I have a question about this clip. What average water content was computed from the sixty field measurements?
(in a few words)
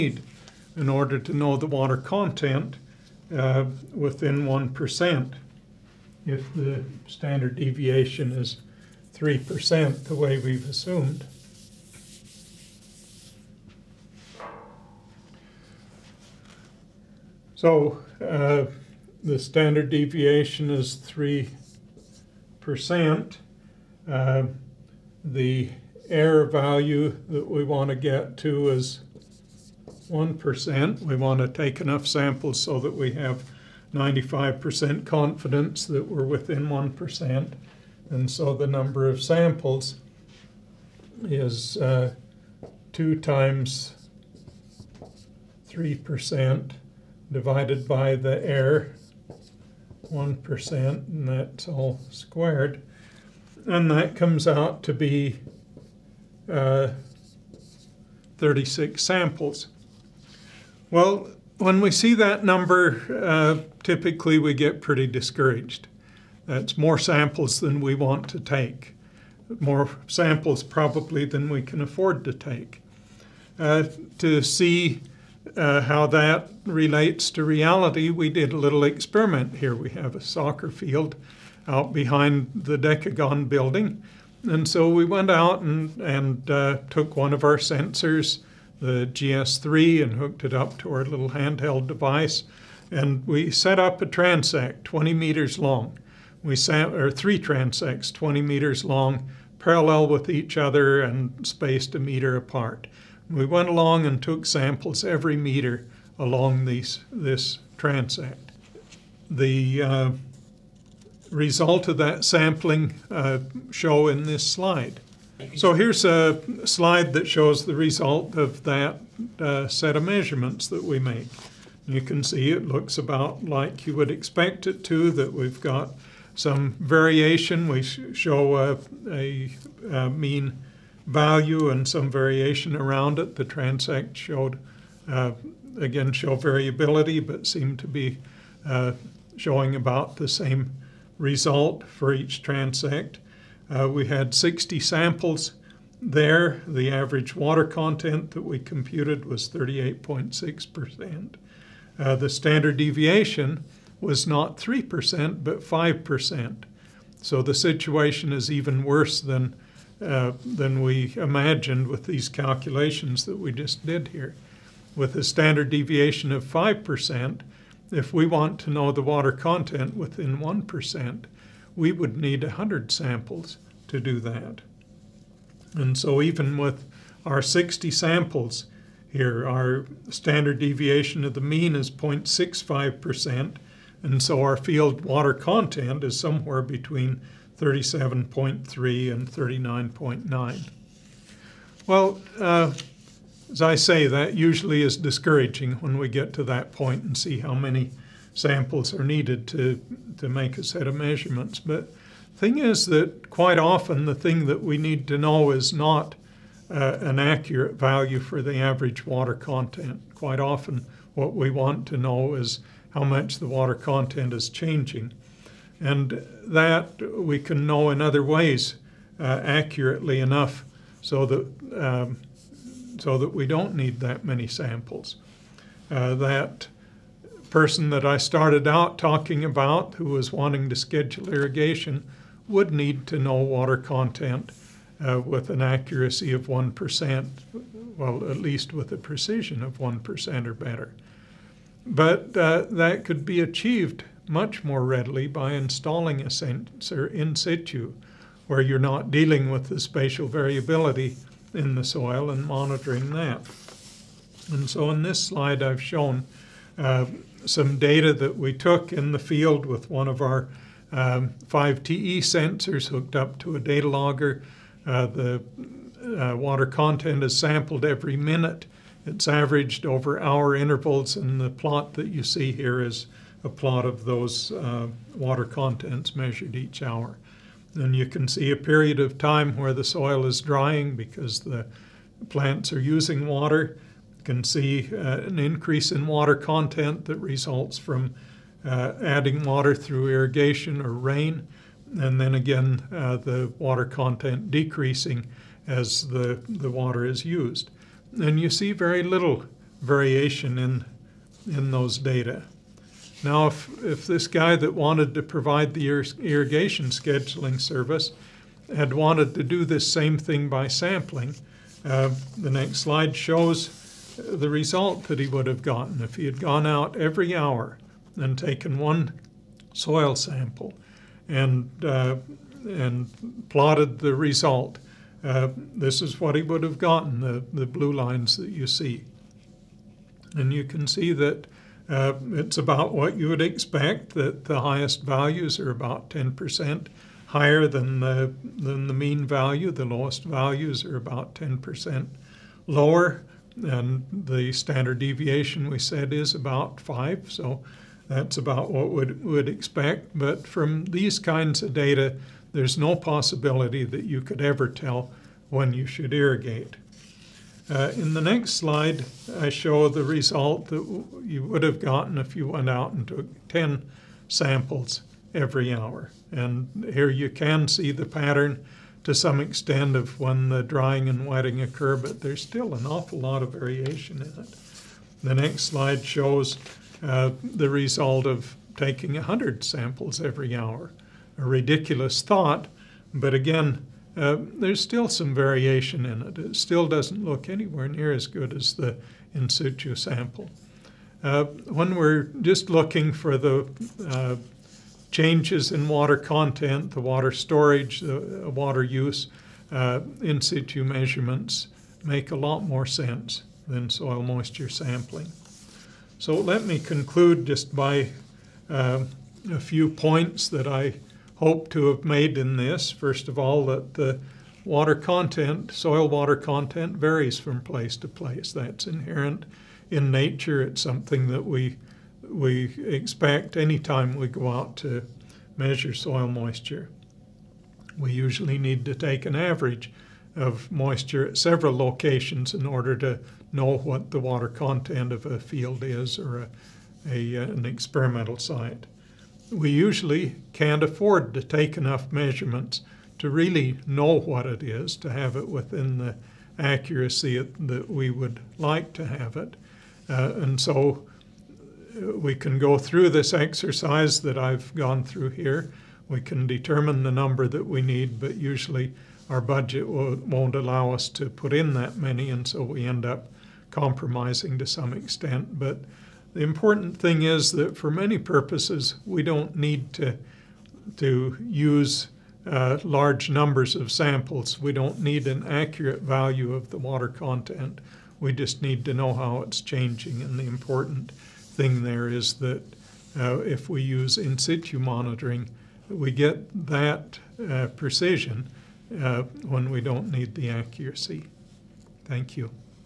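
38.6%.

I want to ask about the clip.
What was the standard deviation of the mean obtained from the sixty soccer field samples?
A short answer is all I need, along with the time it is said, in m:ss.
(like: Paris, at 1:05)
0.65%, at 3:01.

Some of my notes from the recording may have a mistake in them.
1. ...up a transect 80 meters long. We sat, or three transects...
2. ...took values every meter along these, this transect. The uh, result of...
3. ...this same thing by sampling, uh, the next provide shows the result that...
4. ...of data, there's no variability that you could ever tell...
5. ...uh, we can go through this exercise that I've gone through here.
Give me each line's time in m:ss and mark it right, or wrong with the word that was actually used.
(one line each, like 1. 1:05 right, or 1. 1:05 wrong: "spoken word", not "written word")
1. 1:33 wrong: "20", not "80"
2. 1:44 wrong: "samples", not "values"
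3. 5:09 wrong: "slide", not "provide"
4. 5:51 wrong: "possibility", not "variability"
5. 7:31 right.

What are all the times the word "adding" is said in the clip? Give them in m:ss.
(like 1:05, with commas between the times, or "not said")
4:49.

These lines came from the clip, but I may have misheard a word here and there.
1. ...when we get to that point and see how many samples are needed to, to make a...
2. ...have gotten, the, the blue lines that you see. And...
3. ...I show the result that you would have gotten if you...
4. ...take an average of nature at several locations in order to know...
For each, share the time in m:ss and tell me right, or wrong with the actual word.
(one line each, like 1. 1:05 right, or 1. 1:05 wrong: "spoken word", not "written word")
1. 3:15 right
2. 5:26 right
3. 5:59 right
4. 7:08 wrong: "moisture", not "nature".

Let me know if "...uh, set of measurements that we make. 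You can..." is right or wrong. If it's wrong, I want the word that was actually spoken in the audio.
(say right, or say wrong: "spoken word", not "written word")
right.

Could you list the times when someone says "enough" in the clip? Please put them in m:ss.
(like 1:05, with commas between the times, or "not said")
0:31, 3:40, 7:21.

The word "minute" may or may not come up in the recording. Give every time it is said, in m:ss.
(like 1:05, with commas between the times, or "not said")
4:28.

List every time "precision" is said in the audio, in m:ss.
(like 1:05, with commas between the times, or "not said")
3:58, 8:07.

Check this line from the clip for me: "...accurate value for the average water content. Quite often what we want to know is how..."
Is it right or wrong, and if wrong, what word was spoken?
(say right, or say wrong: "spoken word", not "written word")
right.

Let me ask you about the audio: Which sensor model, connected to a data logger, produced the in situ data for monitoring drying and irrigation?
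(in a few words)
5TE.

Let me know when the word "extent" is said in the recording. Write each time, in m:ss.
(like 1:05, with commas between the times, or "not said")
6:09, 7:44.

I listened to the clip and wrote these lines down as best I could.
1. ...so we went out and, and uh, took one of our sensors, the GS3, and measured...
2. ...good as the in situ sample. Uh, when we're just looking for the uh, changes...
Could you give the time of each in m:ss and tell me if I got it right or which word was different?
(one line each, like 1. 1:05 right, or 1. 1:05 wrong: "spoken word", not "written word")
1. 1:24 wrong: "hooked", not "measured"
2. 6:28 right.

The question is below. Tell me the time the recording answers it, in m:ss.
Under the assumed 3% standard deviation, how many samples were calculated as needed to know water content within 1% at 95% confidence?
0:58.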